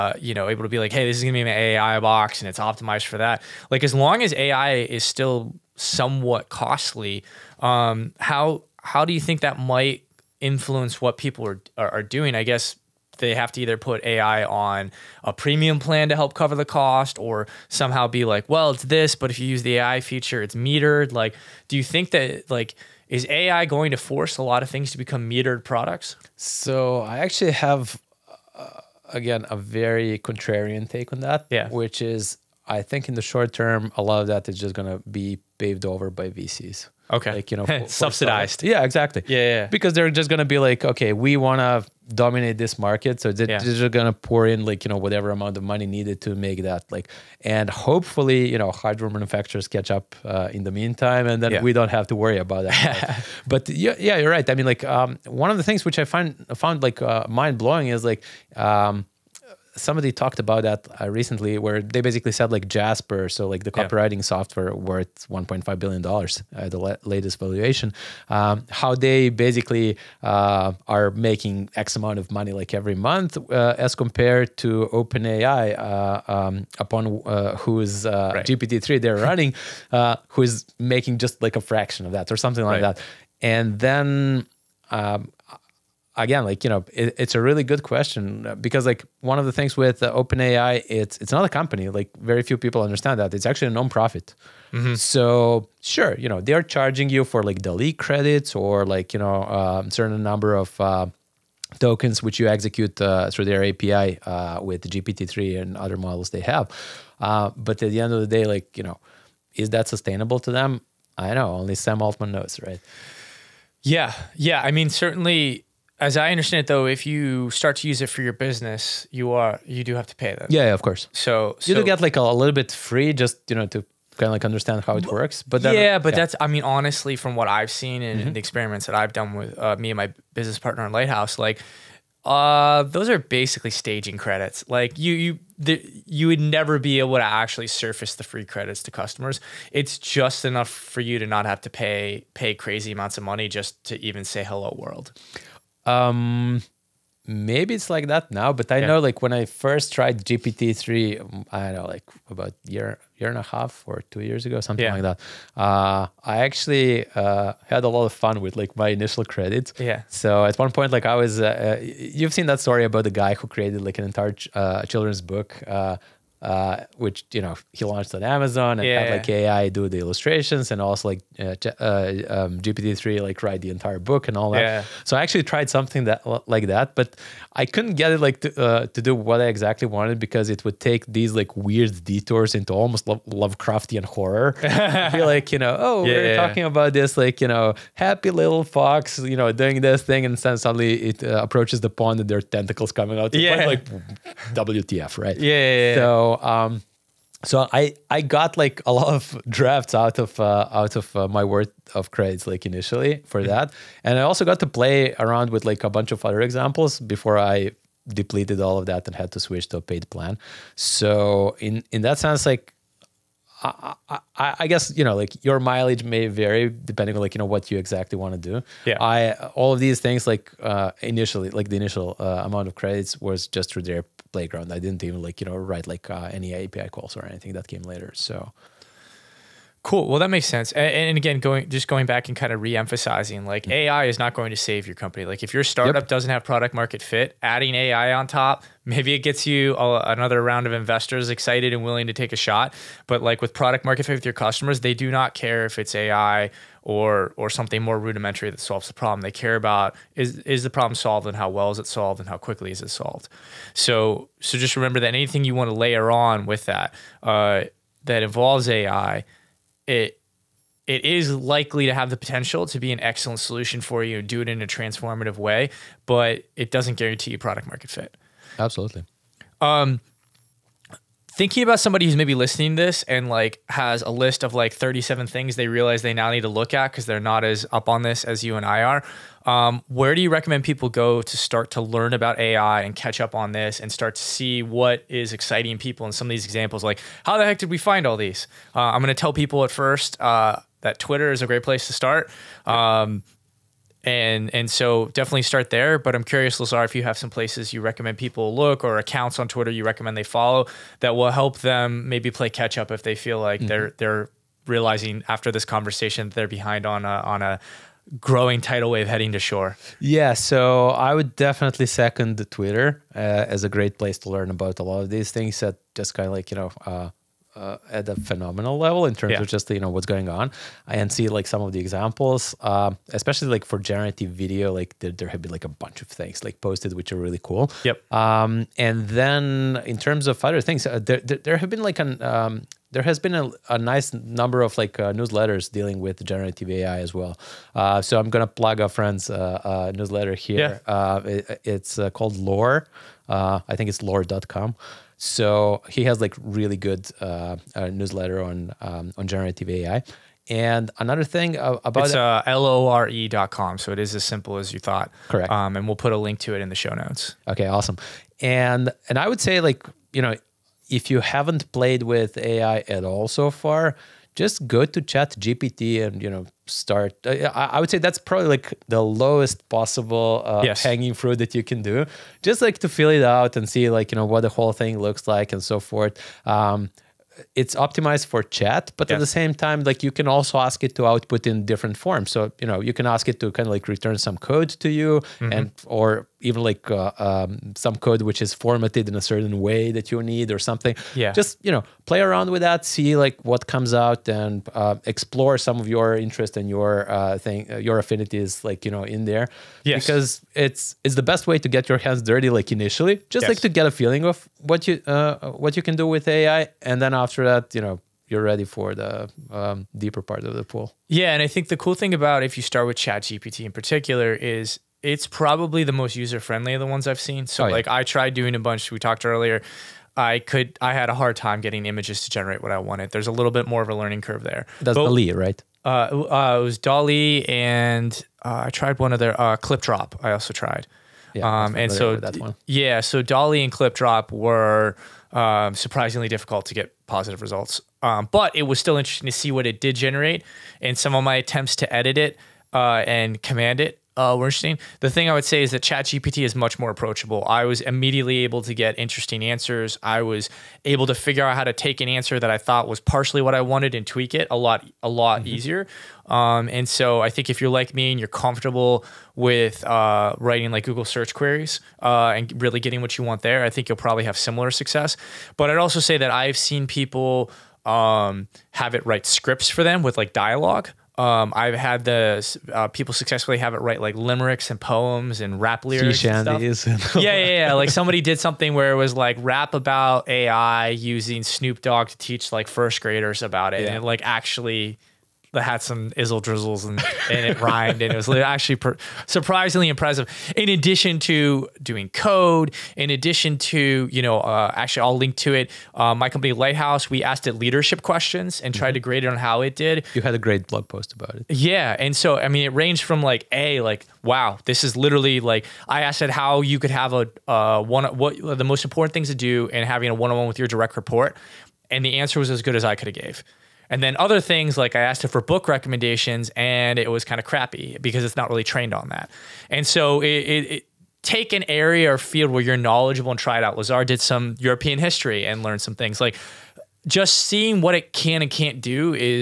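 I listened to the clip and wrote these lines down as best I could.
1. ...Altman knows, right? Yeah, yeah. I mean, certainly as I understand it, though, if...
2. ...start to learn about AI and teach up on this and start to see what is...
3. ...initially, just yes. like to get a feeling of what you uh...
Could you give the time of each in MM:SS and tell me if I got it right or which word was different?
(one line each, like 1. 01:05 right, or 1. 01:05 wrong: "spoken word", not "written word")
1. 01:52 right
2. 04:41 wrong: "catch", not "teach"
3. 06:42 right.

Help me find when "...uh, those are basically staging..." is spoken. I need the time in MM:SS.
02:12.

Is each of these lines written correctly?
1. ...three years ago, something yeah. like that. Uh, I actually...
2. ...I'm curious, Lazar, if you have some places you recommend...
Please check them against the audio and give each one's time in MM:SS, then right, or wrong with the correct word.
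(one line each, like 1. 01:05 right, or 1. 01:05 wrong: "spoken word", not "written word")
1. 02:34 wrong: "two", not "three"
2. 04:56 right.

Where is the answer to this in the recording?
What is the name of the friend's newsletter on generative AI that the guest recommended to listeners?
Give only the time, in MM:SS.
05:42.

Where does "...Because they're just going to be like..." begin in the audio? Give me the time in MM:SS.
00:39.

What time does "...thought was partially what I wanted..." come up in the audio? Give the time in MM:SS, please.
07:32.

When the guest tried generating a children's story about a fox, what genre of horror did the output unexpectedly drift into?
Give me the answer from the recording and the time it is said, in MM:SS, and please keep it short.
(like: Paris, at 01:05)
Lovecraftian, at 03:03.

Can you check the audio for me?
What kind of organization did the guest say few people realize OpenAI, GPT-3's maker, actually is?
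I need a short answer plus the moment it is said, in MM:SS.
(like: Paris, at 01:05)
nonprofit, at 01:33.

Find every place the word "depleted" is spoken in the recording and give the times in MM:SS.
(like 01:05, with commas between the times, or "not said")
03:28.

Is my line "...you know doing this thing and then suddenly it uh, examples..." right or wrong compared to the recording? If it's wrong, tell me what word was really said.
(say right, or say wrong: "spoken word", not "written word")
wrong: "approaches", not "examples".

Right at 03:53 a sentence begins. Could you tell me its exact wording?
AI is not going to save your company.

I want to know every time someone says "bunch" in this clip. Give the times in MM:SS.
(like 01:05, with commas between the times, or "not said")
03:25, 05:25, 06:58.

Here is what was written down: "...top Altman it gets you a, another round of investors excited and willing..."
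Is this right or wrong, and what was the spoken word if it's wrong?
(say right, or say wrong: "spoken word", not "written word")
wrong: "Maybe", not "Altman".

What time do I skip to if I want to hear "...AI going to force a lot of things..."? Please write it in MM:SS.
00:23.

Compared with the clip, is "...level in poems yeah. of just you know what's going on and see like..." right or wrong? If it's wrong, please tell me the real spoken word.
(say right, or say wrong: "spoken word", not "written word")
wrong: "terms", not "poems".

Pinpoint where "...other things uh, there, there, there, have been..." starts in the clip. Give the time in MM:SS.
05:30.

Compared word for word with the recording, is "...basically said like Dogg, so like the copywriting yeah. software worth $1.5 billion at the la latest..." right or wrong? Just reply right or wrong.
wrong.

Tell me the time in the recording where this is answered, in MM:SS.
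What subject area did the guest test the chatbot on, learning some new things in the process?
08:44.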